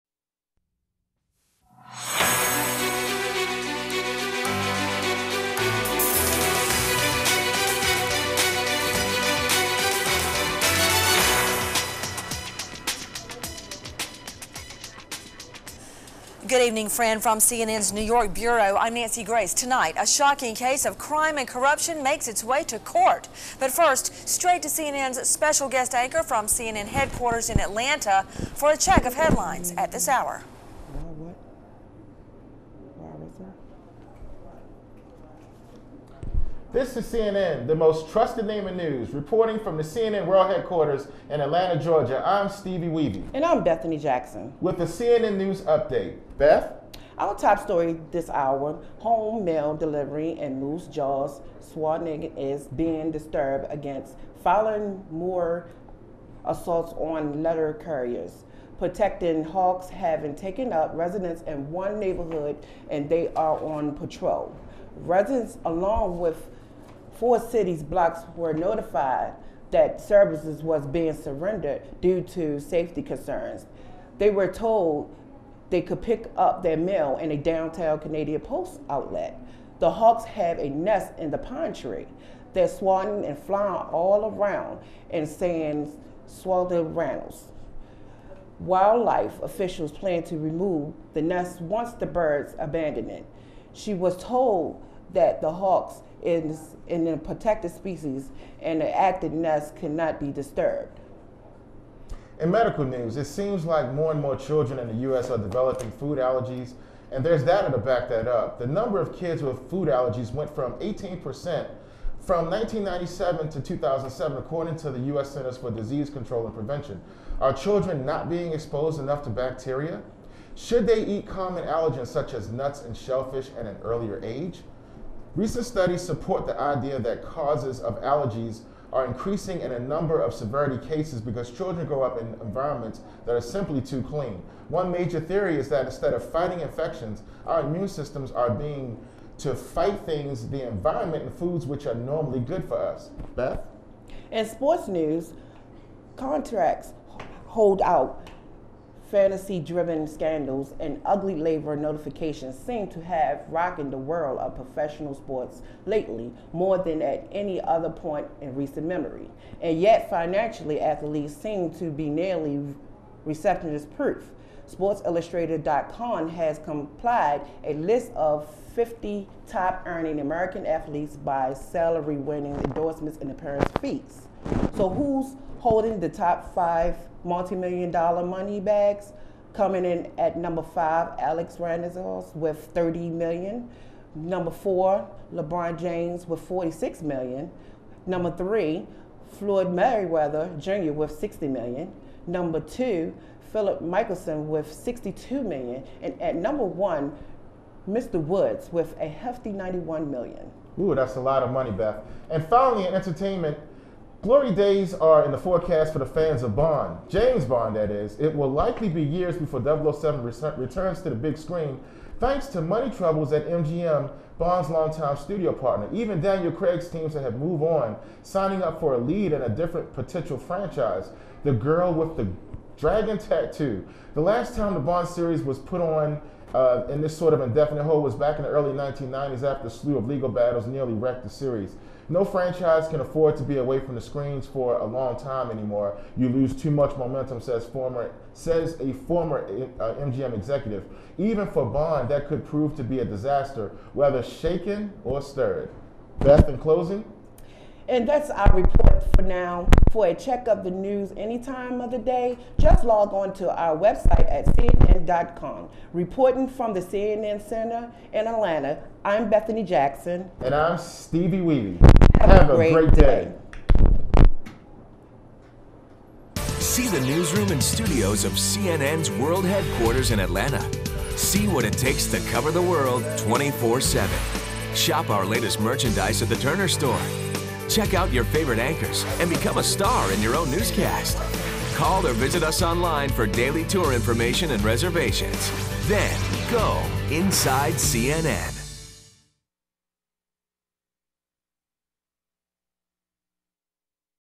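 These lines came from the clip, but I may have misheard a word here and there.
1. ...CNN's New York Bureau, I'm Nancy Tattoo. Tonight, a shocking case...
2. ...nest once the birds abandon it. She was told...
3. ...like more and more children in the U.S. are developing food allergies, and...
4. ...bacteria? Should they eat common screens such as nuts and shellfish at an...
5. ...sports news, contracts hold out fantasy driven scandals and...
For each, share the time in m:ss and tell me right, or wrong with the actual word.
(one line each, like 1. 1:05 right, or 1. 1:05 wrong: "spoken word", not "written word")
1. 0:17 wrong: "Grace", not "Tattoo"
2. 1:31 right
3. 1:43 right
4. 1:59 wrong: "allergens", not "screens"
5. 2:24 right.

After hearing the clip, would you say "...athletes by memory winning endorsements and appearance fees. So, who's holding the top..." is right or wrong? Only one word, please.
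wrong.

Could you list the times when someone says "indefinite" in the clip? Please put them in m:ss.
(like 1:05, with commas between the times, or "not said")
3:47.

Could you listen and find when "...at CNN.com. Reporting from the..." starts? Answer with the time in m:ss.
4:14.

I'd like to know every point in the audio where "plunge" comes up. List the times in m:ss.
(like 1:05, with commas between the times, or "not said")
not said.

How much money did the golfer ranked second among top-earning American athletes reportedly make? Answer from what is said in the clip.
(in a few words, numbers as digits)
62 million.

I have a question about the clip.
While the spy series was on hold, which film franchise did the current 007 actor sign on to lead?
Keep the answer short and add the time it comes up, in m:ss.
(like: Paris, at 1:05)
The Girl with the Dragon Tattoo, at 3:41.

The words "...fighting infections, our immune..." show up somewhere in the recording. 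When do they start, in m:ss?
2:16.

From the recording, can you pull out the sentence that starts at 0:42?
I'm Stevieweevie, And I'm Bethany Jackson.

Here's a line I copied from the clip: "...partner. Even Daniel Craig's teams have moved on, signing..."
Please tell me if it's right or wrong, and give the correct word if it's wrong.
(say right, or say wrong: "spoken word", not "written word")
right.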